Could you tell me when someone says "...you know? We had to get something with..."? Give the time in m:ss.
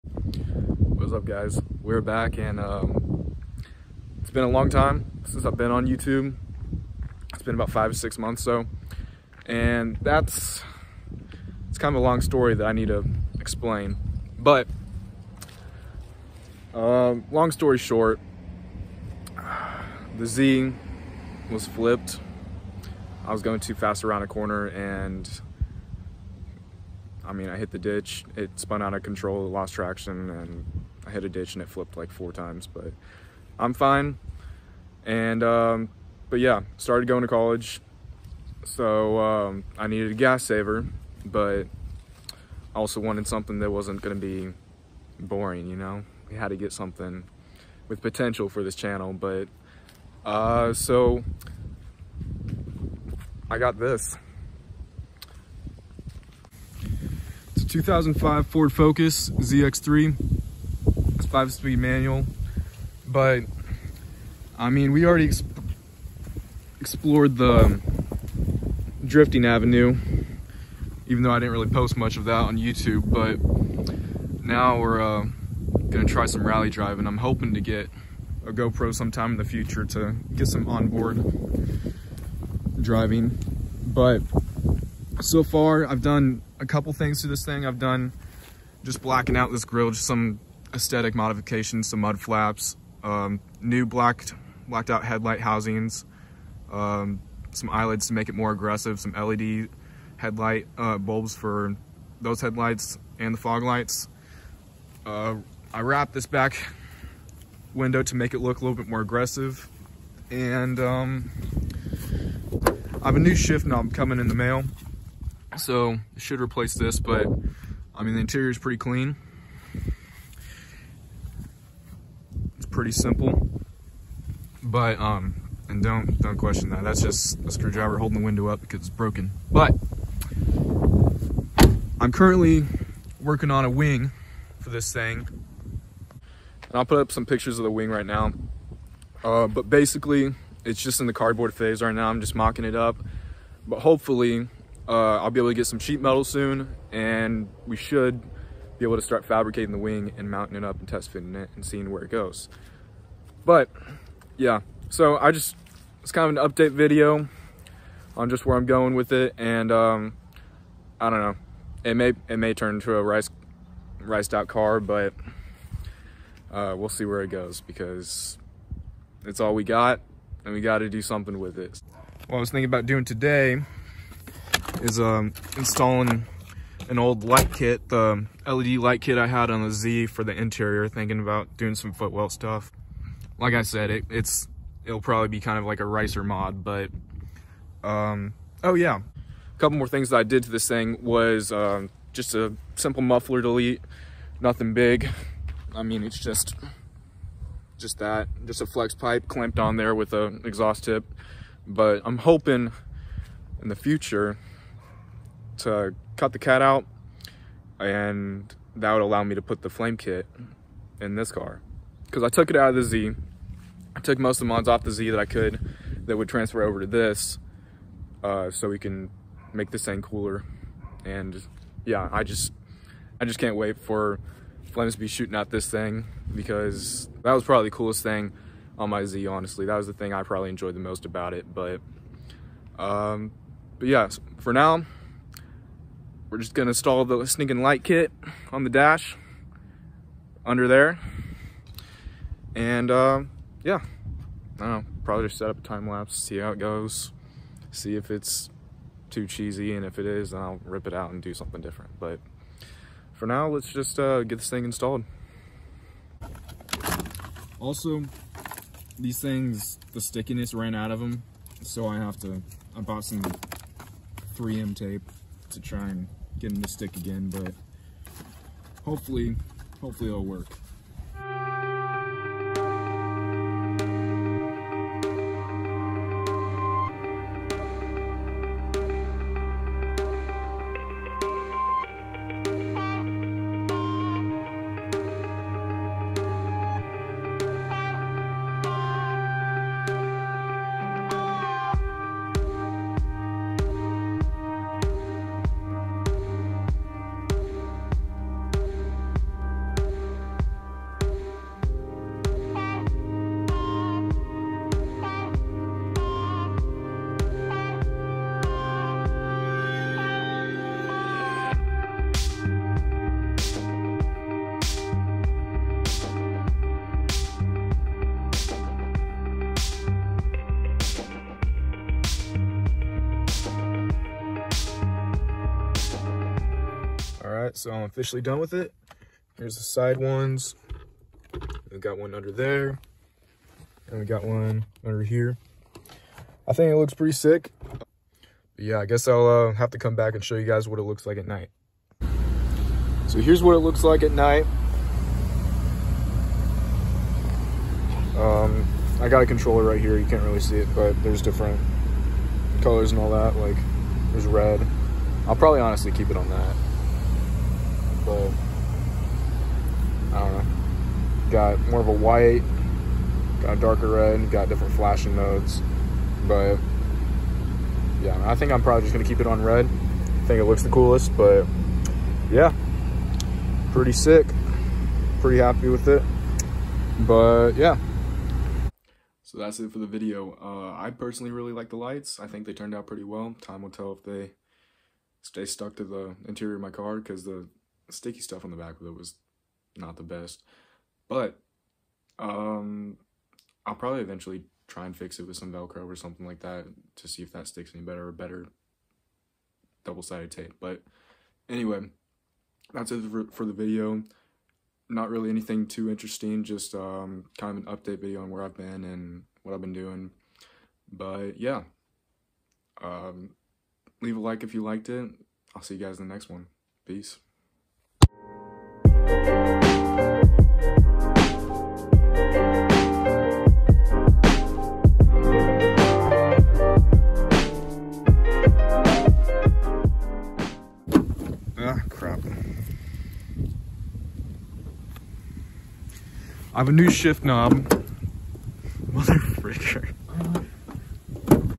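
0:45.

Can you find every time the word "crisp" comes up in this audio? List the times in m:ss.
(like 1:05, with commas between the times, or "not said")
not said.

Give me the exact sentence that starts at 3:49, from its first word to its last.
That was the thing I probably enjoyed the most about it.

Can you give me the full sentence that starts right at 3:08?
A couple more things that I did to this thing was um, just a simple muffler delete, nothing big.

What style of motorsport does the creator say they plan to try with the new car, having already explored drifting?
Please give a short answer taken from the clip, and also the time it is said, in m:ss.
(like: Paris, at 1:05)
Rally driving, at 1:16.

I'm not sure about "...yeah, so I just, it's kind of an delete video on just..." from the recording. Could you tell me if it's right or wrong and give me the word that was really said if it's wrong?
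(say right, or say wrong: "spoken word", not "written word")
wrong: "update", not "delete".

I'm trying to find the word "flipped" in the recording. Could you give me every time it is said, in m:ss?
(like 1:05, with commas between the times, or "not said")
0:21, 0:31.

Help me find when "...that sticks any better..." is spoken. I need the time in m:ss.
6:37.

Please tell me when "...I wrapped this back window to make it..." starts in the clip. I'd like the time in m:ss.
1:45.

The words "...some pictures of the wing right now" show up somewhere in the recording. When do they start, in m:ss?
2:17.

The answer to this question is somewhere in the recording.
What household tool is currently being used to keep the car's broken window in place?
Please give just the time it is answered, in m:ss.
2:07.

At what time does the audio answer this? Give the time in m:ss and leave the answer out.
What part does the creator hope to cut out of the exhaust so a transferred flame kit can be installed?
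3:26.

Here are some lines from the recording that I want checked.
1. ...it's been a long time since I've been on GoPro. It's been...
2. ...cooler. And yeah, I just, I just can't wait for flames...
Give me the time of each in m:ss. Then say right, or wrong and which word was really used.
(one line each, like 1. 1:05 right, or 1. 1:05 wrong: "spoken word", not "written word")
1. 0:04 wrong: "YouTube", not "GoPro"
2. 3:40 right.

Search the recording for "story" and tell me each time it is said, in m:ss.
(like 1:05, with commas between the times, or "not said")
0:12, 0:17.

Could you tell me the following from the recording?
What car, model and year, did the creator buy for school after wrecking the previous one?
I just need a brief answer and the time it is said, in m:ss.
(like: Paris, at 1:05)
2005 Ford Focus ZX3, at 0:57.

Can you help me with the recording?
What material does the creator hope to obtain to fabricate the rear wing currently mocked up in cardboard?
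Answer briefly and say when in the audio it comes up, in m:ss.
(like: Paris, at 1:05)
Sheet metal, at 2:25.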